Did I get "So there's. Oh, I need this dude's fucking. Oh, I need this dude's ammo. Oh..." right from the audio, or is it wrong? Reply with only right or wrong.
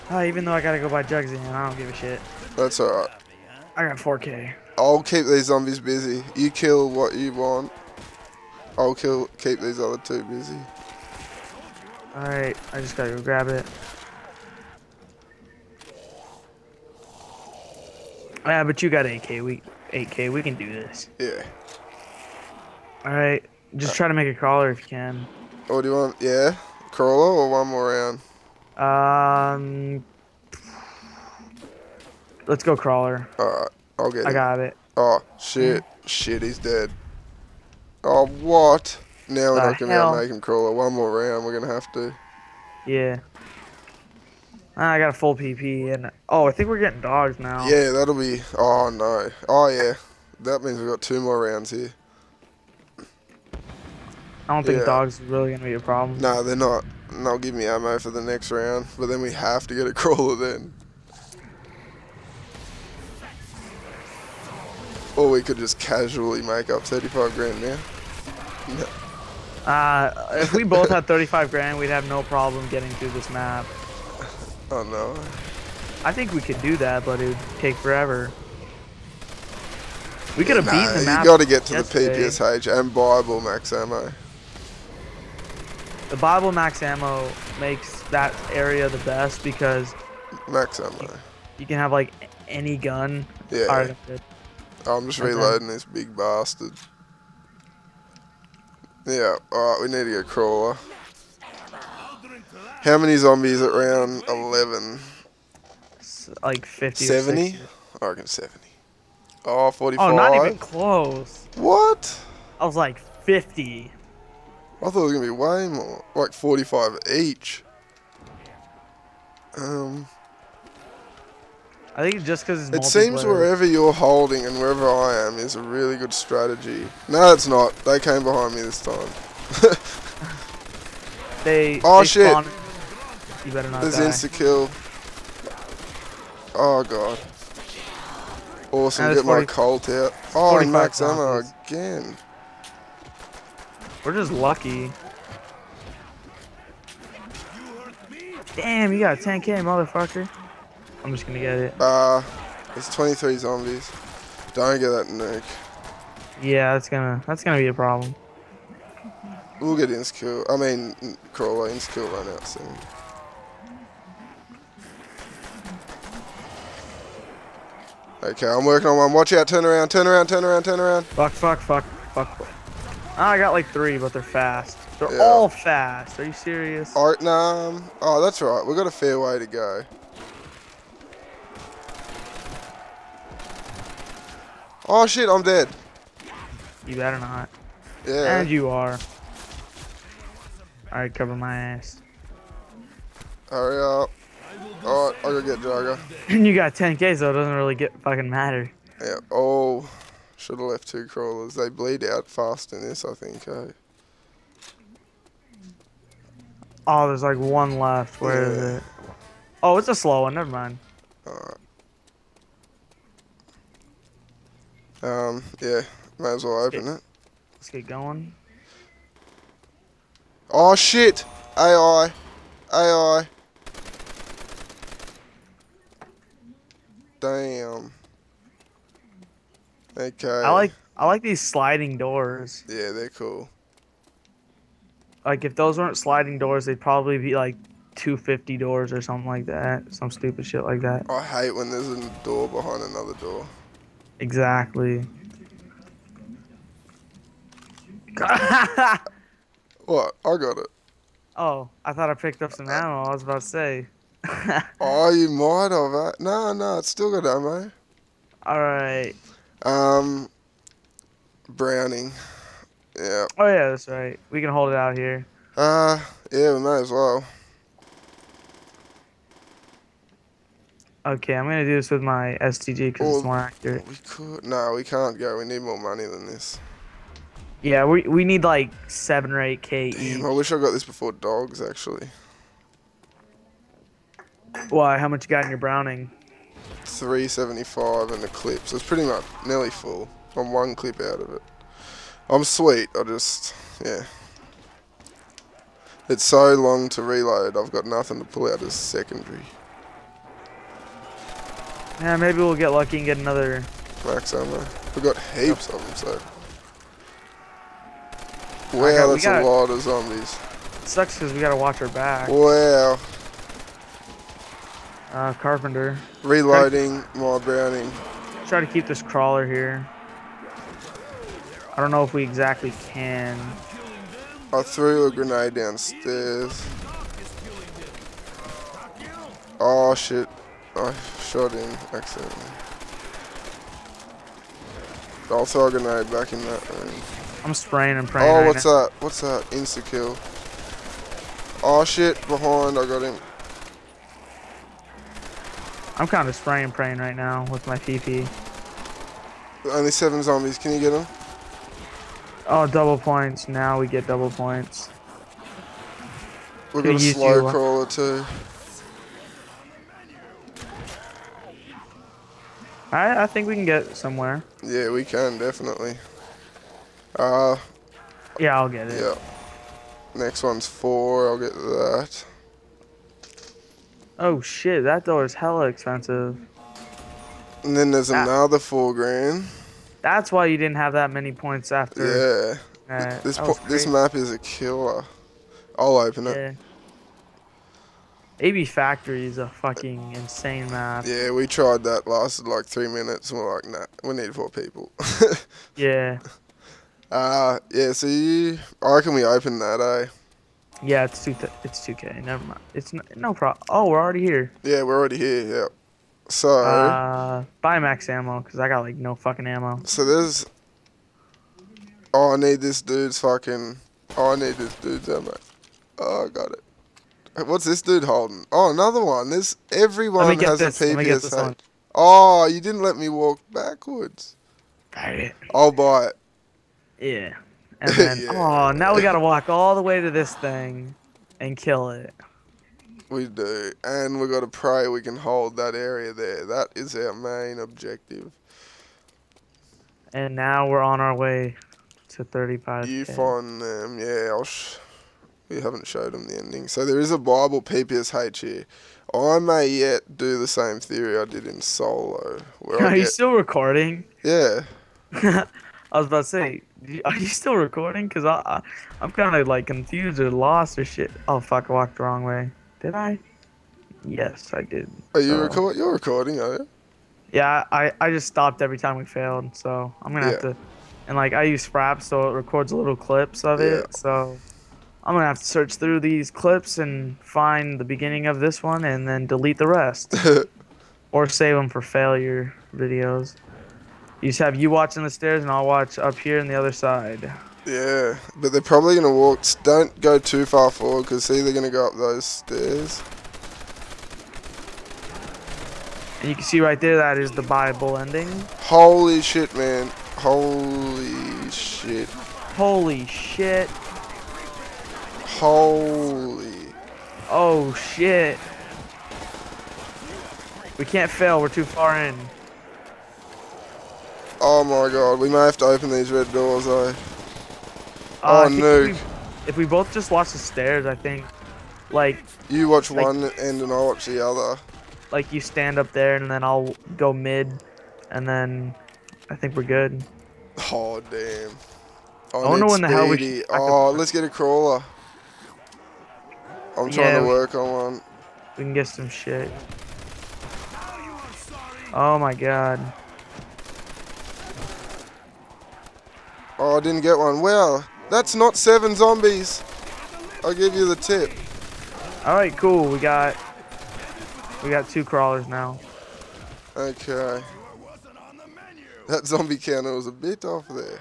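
right.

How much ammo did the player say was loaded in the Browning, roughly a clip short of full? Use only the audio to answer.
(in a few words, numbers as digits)
375.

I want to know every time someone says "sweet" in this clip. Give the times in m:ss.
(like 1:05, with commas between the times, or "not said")
4:52.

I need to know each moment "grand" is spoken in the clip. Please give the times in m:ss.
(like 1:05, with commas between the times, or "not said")
1:07, 1:11, 6:18.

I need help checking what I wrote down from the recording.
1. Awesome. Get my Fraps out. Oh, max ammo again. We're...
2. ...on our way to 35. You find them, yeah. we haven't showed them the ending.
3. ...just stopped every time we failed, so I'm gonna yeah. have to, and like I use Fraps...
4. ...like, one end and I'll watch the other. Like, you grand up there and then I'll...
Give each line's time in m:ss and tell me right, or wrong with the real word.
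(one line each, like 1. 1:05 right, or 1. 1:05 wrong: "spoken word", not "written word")
1. 2:18 wrong: "Colt", not "Fraps"
2. 7:20 right
3. 7:48 right
4. 8:42 wrong: "stand", not "grand".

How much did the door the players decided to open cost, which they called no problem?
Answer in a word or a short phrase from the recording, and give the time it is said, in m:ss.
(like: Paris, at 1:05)
2K, at 6:41.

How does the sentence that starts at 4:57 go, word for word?
I've got nothing to pull out as secondary.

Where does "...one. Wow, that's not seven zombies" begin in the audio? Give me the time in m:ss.
9:07.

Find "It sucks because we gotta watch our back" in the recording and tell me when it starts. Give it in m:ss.
5:10.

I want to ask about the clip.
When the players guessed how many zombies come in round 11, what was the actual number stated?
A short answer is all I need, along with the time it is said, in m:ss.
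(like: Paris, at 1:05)
45, at 1:49.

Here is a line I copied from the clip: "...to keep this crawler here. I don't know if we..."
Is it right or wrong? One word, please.
right.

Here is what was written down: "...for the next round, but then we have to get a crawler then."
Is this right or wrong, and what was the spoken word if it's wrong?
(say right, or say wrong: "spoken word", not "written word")
right.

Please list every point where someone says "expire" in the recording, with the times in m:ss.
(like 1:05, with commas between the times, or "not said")
not said.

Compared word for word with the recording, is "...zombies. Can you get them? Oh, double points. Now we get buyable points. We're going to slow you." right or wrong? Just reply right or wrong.
wrong.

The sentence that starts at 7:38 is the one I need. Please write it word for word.
Cause I, I I'm kind of like confused or lost or shit.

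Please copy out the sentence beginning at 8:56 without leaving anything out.
I'm trying yeah, to work we, on one.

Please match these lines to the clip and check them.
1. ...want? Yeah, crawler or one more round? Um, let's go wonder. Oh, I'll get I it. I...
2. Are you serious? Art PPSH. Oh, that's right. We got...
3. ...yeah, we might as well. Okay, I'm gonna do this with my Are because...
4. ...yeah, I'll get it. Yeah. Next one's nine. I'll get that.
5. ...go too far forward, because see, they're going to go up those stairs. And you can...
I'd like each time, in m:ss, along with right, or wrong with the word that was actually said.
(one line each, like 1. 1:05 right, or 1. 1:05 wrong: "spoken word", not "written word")
1. 0:25 wrong: "crawler", not "wonder"
2. 2:56 wrong: "Nam", not "PPSH"
3. 4:26 wrong: "STG", not "Are"
4. 6:08 wrong: "four", not "nine"
5. 8:09 right.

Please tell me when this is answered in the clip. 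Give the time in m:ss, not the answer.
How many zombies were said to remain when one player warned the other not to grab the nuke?
2:32.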